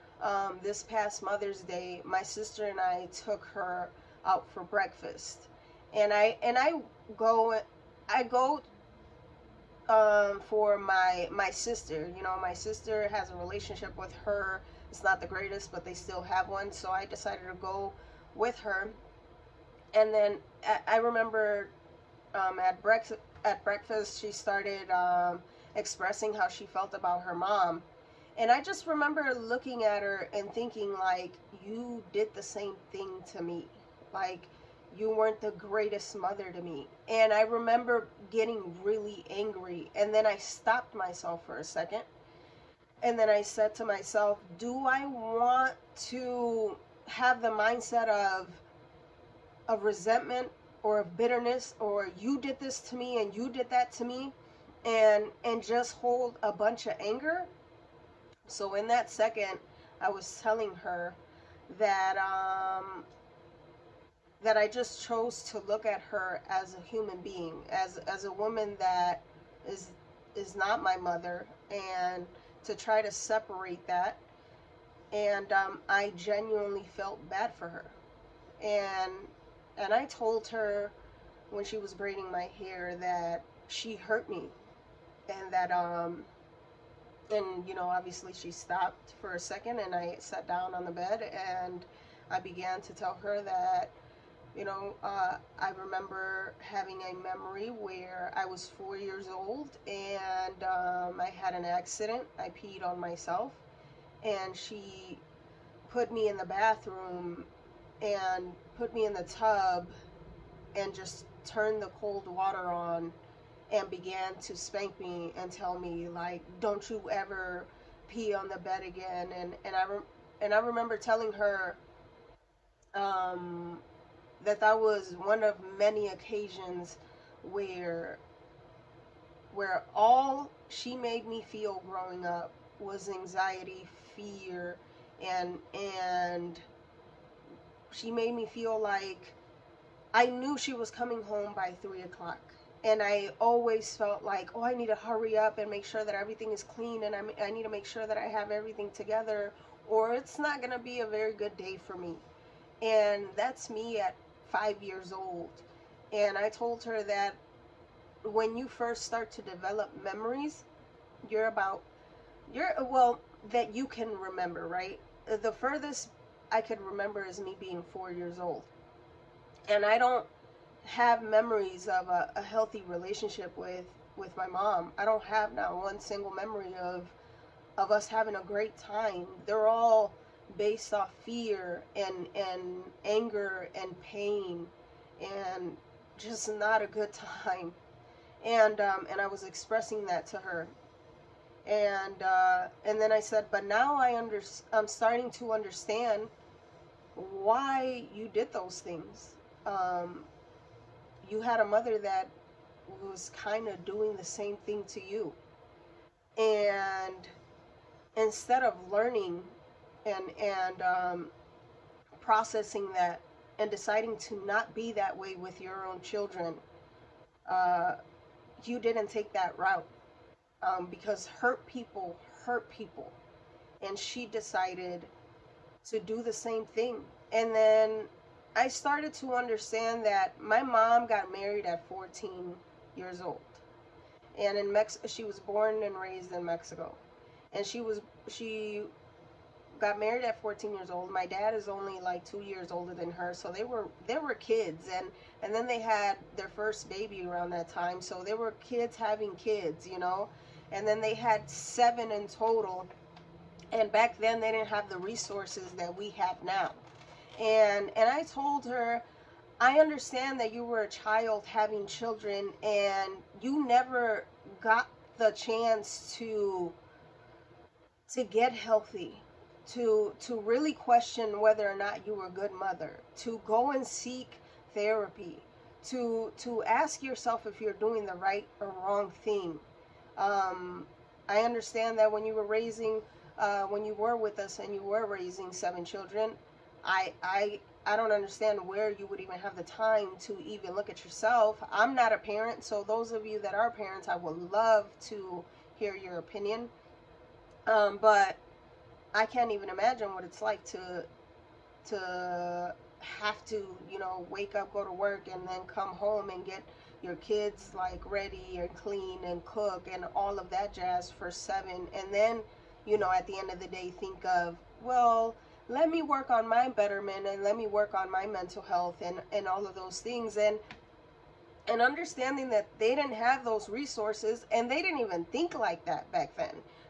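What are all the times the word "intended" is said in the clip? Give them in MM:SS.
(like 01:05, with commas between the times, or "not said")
not said.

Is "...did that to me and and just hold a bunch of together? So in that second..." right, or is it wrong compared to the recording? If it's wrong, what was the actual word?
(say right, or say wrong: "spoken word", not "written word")
wrong: "anger", not "together".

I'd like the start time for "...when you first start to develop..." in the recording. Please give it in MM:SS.
02:38.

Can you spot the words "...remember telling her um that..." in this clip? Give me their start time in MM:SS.
02:00.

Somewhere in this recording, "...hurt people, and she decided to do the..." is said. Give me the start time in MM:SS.
03:42.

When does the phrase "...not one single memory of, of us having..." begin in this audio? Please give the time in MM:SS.
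02:55.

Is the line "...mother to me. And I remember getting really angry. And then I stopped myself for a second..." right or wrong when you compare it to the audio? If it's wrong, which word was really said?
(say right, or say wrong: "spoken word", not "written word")
right.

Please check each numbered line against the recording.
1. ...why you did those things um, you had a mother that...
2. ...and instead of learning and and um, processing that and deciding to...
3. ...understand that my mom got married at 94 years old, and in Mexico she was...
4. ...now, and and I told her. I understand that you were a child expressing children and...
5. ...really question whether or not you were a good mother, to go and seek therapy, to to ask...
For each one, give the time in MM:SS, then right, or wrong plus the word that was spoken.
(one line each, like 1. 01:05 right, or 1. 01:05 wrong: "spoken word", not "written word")
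1. 03:17 right
2. 03:26 right
3. 03:49 wrong: "14", not "94"
4. 04:16 wrong: "having", not "expressing"
5. 04:30 right.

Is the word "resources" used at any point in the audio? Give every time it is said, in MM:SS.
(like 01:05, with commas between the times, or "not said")
04:14, 05:23.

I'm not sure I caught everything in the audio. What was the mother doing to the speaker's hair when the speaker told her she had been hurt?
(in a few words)
Braiding.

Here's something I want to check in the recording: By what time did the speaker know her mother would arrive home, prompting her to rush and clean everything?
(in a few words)
3 o'clock.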